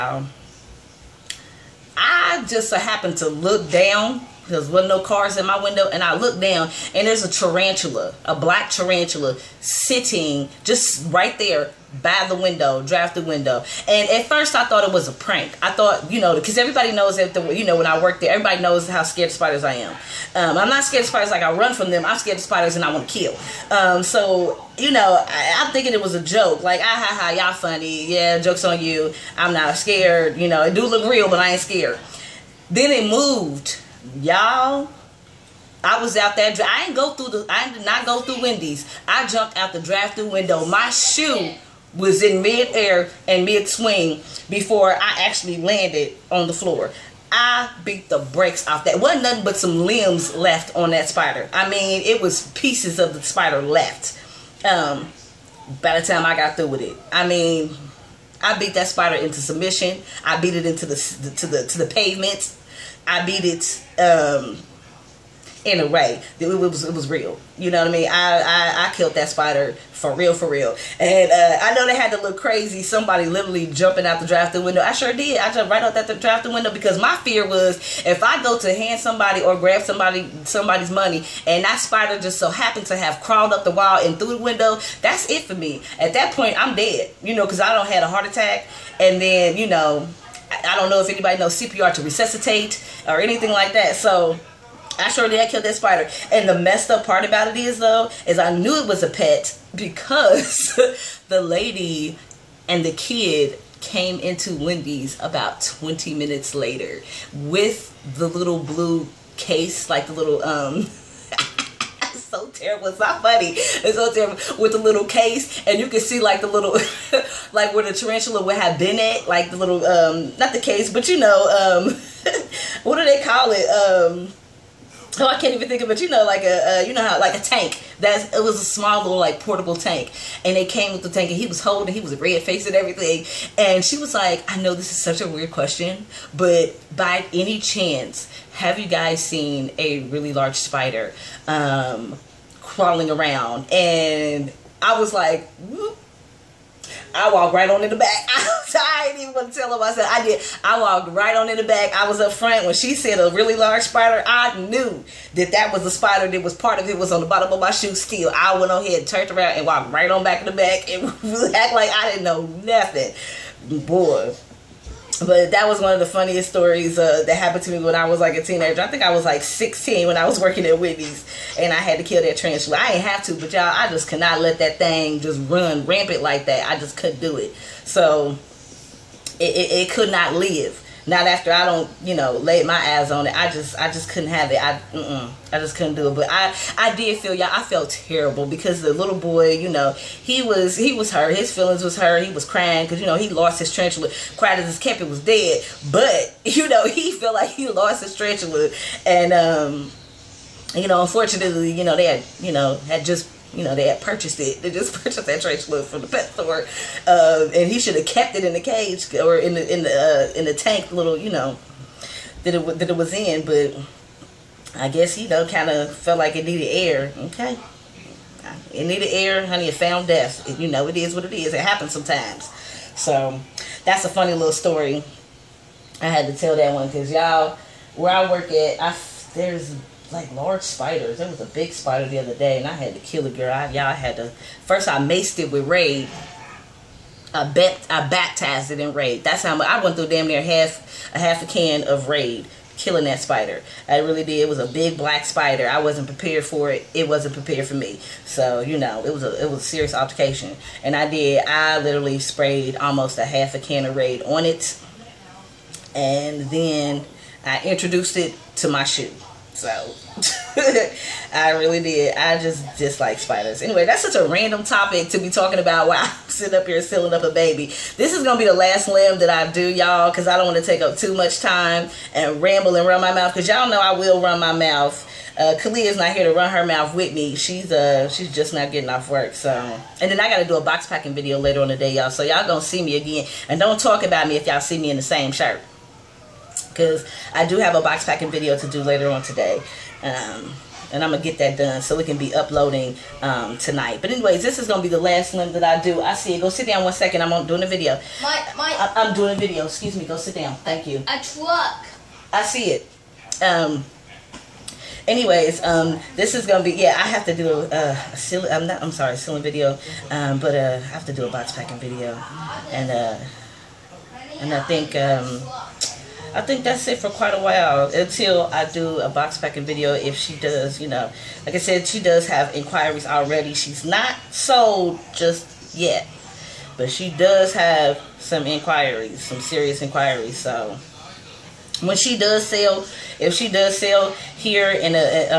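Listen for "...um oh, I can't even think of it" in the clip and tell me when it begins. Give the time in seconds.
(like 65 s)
123 s.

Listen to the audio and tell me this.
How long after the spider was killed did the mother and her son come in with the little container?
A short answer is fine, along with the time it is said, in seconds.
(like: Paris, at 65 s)
20 minutes, at 105 s.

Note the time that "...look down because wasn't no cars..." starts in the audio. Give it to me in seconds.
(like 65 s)
3 s.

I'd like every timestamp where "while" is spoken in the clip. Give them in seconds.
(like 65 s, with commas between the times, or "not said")
265 s, 317 s.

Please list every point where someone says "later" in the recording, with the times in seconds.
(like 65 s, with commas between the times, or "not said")
106 s, 281 s, 288 s.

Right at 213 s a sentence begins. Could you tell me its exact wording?
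But I guess you know, kind of felt like it needed air.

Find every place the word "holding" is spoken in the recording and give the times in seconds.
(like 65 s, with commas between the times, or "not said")
131 s.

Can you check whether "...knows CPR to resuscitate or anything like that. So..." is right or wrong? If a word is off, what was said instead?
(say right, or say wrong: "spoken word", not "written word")
right.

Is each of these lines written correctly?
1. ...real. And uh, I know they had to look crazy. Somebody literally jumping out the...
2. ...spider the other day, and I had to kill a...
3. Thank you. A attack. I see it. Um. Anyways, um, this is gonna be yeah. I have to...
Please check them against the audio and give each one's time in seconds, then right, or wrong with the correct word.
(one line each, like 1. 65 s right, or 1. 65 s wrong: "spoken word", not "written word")
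1. 70 s right
2. 231 s right
3. 300 s wrong: "truck", not "attack".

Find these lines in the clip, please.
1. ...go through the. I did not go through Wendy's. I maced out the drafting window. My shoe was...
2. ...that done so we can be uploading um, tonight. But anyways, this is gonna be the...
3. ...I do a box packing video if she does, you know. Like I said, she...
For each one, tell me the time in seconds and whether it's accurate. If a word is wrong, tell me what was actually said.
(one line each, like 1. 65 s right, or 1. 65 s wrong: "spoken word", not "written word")
1. 36 s wrong: "jumped", not "maced"
2. 291 s right
3. 318 s right.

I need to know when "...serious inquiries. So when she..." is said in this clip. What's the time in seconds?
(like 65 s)
329 s.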